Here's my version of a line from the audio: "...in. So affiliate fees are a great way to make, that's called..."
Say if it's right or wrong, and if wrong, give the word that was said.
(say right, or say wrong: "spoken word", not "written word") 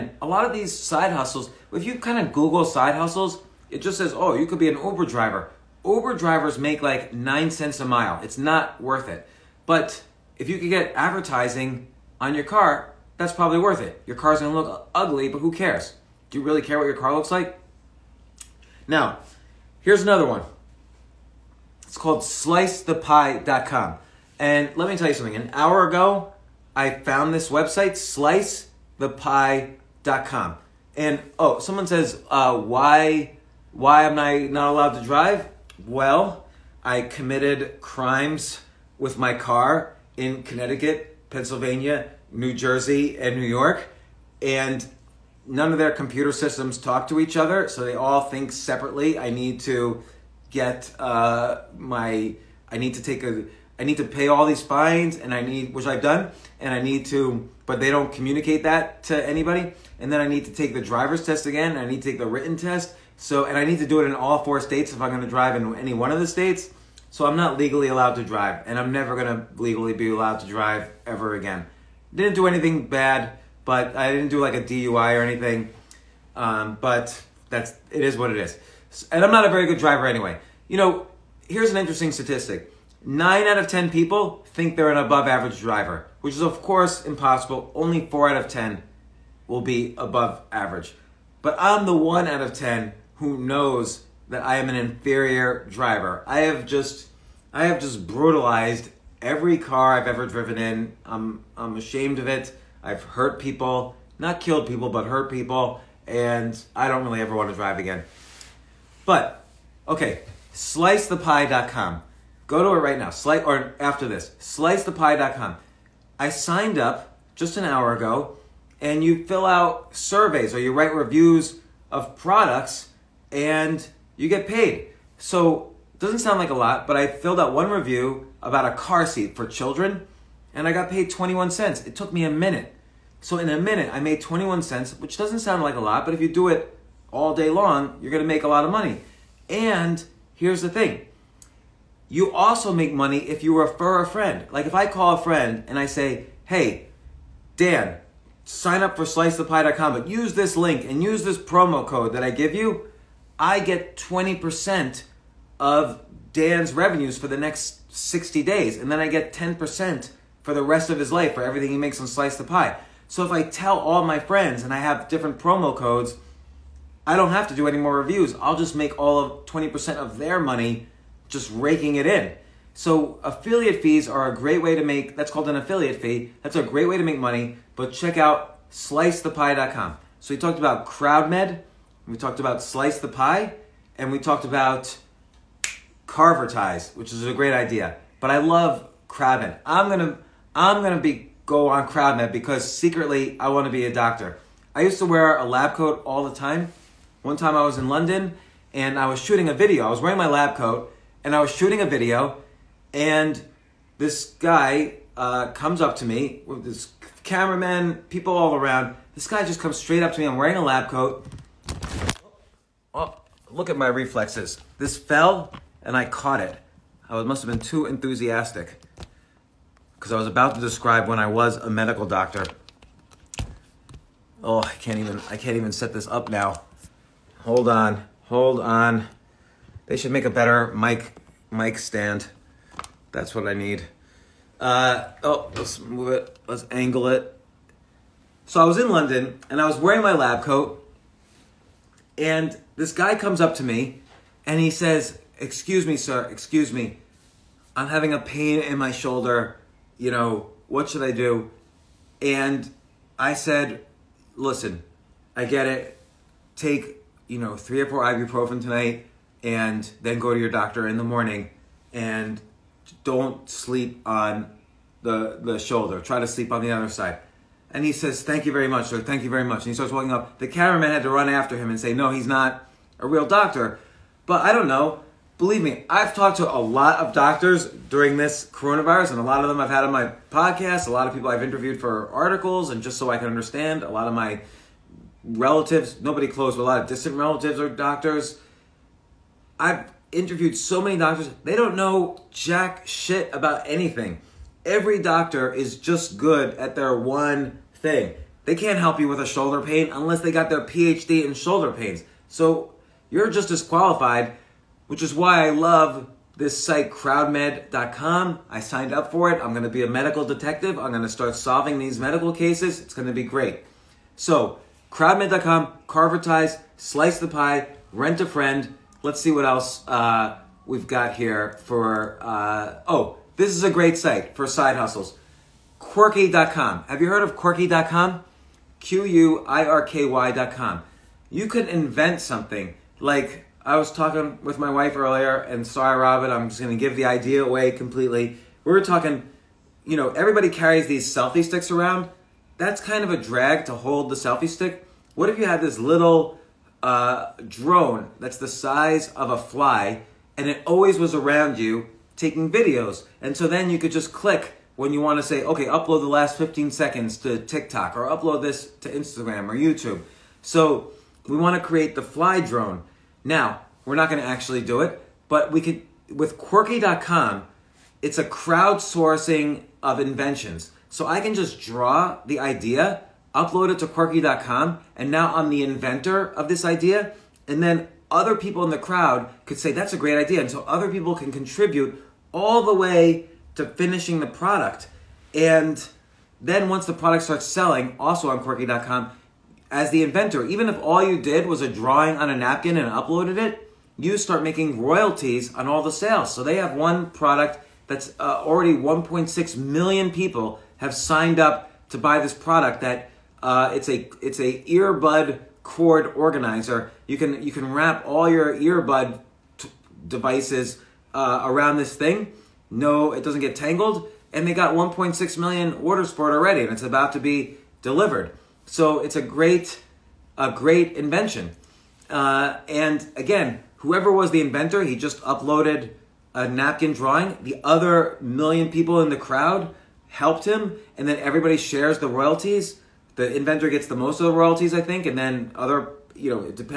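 right.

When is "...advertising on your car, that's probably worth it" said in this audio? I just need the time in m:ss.
0:10.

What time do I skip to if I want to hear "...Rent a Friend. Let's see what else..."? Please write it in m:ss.
5:17.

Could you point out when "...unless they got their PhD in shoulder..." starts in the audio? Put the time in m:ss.
4:59.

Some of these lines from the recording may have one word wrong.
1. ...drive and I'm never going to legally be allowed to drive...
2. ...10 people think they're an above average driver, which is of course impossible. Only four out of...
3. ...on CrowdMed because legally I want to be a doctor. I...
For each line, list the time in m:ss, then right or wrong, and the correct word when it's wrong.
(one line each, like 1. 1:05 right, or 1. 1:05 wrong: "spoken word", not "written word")
1. 1:08 right
2. 1:23 right
3. 3:11 wrong: "secretly", not "legally".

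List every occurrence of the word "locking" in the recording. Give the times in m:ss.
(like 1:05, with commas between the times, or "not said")
not said.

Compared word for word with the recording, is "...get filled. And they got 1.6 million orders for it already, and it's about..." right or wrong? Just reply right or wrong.
wrong.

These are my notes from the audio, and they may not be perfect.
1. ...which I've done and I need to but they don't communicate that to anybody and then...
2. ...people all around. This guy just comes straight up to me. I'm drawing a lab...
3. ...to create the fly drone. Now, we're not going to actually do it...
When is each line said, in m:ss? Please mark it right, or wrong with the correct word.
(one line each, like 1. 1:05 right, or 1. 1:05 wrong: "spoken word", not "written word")
1. 0:55 right
2. 3:28 wrong: "wearing", not "drawing"
3. 6:01 right.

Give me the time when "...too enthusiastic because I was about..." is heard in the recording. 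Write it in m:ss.
3:37.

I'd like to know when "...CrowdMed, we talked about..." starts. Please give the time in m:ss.
3:00.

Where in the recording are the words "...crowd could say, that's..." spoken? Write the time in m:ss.
6:18.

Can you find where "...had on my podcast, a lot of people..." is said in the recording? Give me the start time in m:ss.
4:39.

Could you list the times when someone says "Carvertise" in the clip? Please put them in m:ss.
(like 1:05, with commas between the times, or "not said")
3:06, 5:15.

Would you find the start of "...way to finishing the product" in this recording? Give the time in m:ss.
6:22.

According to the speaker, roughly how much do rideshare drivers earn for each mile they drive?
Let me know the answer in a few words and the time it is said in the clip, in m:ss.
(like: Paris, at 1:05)
9 cents, at 0:07.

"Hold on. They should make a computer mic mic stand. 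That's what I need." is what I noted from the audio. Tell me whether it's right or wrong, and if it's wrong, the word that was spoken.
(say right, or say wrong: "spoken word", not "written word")
wrong: "better", not "computer".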